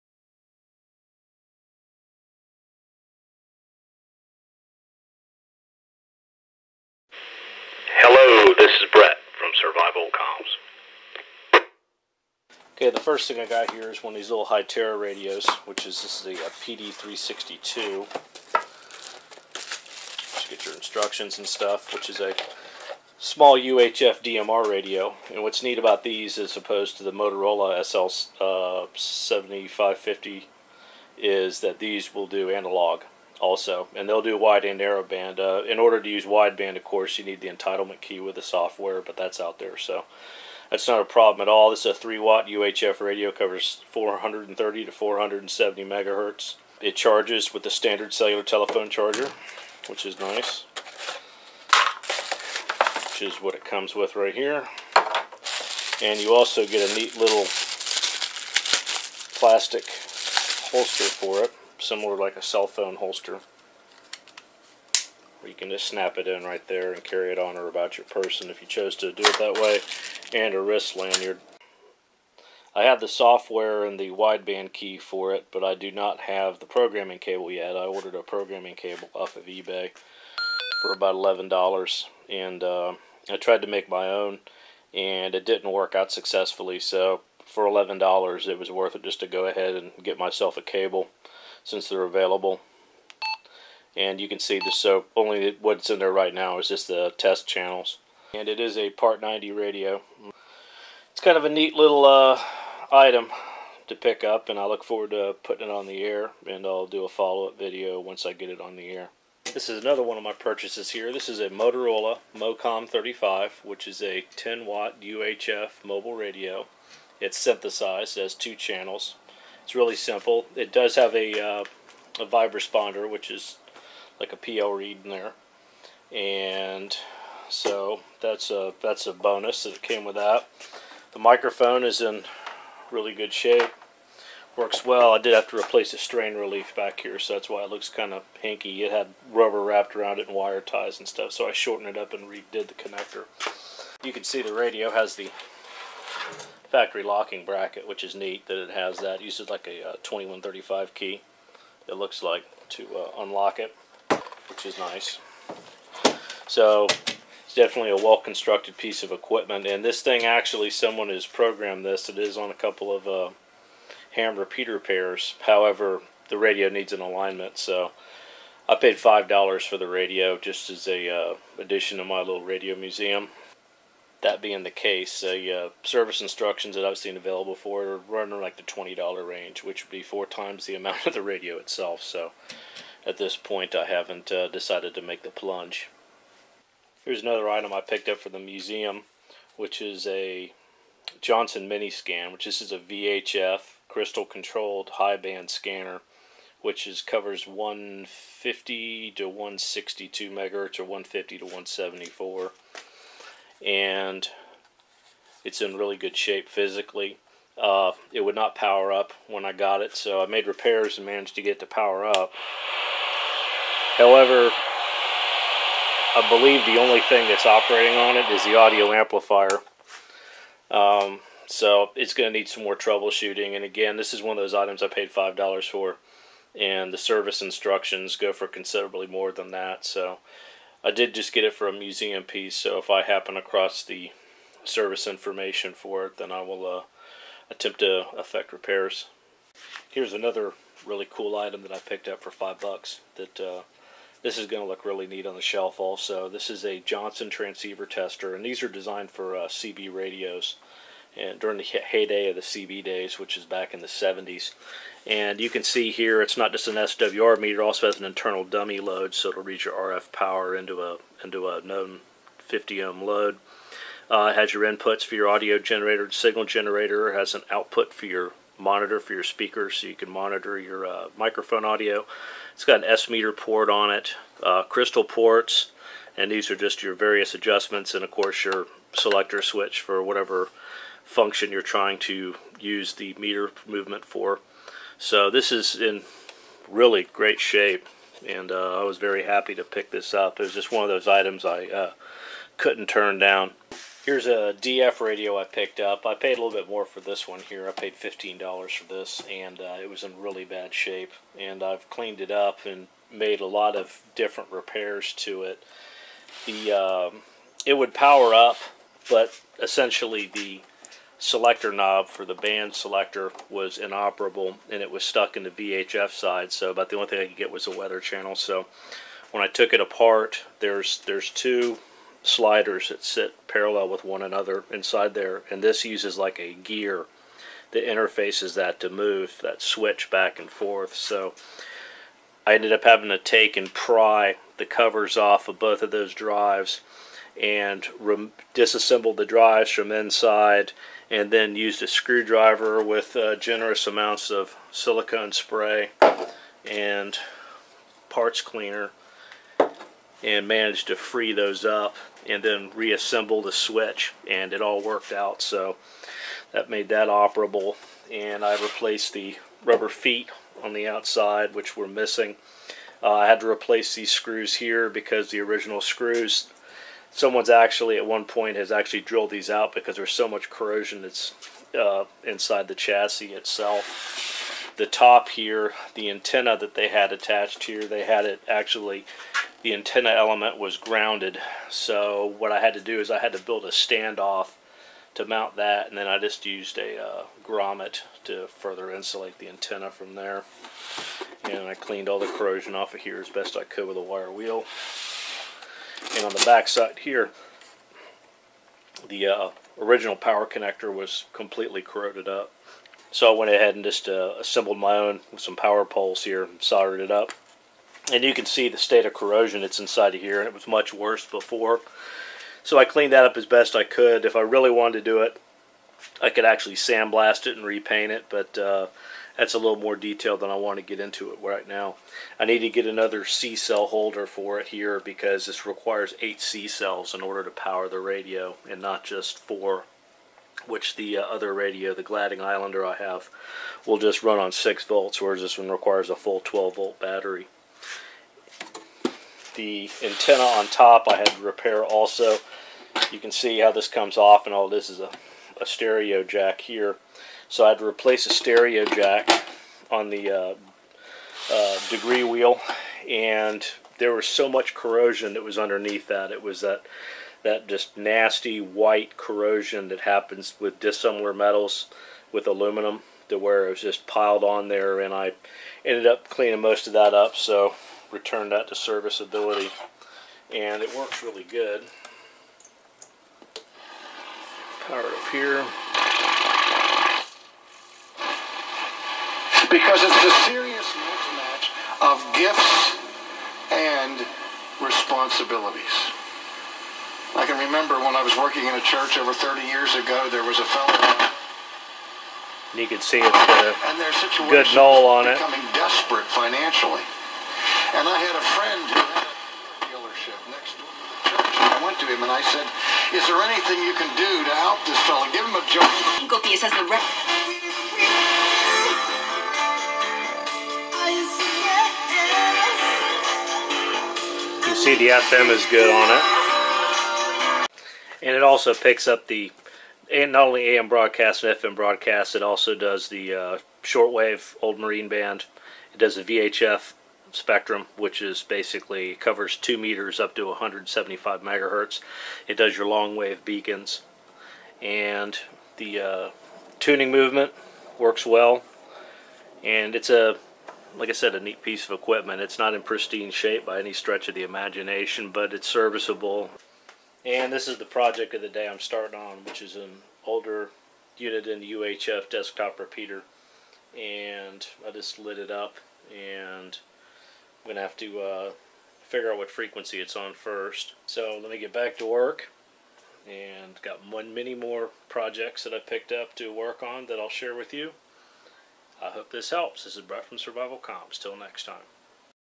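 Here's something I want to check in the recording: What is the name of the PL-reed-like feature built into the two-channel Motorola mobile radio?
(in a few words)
Vibrasponder.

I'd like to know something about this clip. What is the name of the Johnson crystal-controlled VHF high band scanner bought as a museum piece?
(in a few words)
Mini Scan.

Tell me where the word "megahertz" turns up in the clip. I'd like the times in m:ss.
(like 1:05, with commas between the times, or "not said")
0:45, 3:20, 8:51.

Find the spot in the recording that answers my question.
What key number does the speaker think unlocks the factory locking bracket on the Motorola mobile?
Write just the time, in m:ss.
2:30.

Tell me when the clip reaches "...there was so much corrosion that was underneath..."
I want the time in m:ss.
7:33.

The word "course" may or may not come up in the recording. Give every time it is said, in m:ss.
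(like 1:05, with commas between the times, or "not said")
0:36, 4:38.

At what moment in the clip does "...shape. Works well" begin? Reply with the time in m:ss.
2:13.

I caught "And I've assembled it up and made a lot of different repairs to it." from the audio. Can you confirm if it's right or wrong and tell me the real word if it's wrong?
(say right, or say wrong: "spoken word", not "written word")
wrong: "cleaned", not "assembled".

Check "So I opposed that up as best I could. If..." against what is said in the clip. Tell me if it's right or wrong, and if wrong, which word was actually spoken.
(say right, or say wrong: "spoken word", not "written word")
wrong: "cleaned", not "opposed".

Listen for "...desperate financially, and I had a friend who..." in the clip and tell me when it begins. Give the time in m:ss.
8:15.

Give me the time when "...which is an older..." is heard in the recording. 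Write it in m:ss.
9:09.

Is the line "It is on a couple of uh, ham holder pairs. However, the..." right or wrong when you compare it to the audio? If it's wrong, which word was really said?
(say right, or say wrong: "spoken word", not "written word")
wrong: "repeater", not "holder".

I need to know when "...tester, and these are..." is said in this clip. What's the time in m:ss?
4:07.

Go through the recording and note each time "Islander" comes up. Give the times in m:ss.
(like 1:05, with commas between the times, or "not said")
7:12.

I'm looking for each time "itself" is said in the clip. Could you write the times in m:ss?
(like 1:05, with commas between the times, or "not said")
3:01, 6:13.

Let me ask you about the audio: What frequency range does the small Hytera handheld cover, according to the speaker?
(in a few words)
430 to 470 MHz.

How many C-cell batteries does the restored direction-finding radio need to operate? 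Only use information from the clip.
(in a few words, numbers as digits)
8.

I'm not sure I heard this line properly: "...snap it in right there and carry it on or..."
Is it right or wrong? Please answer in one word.
right.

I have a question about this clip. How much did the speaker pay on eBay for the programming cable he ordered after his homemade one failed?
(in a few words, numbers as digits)
$11.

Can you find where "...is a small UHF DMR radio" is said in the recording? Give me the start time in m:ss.
0:22.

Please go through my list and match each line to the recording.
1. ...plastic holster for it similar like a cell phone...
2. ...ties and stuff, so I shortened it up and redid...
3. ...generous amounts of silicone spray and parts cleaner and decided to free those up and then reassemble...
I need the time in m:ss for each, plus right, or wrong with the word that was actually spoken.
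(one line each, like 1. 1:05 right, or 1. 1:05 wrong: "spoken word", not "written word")
1. 0:59 right
2. 2:20 right
3. 5:43 wrong: "managed", not "decided".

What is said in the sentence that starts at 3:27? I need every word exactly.
Uh, it would not power up when I got it, so I made repairs and managed to get it to power up.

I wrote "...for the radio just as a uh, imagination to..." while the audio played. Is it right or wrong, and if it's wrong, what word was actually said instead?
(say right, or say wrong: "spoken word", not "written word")
wrong: "addition", not "imagination".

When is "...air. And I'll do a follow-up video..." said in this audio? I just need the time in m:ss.
1:46.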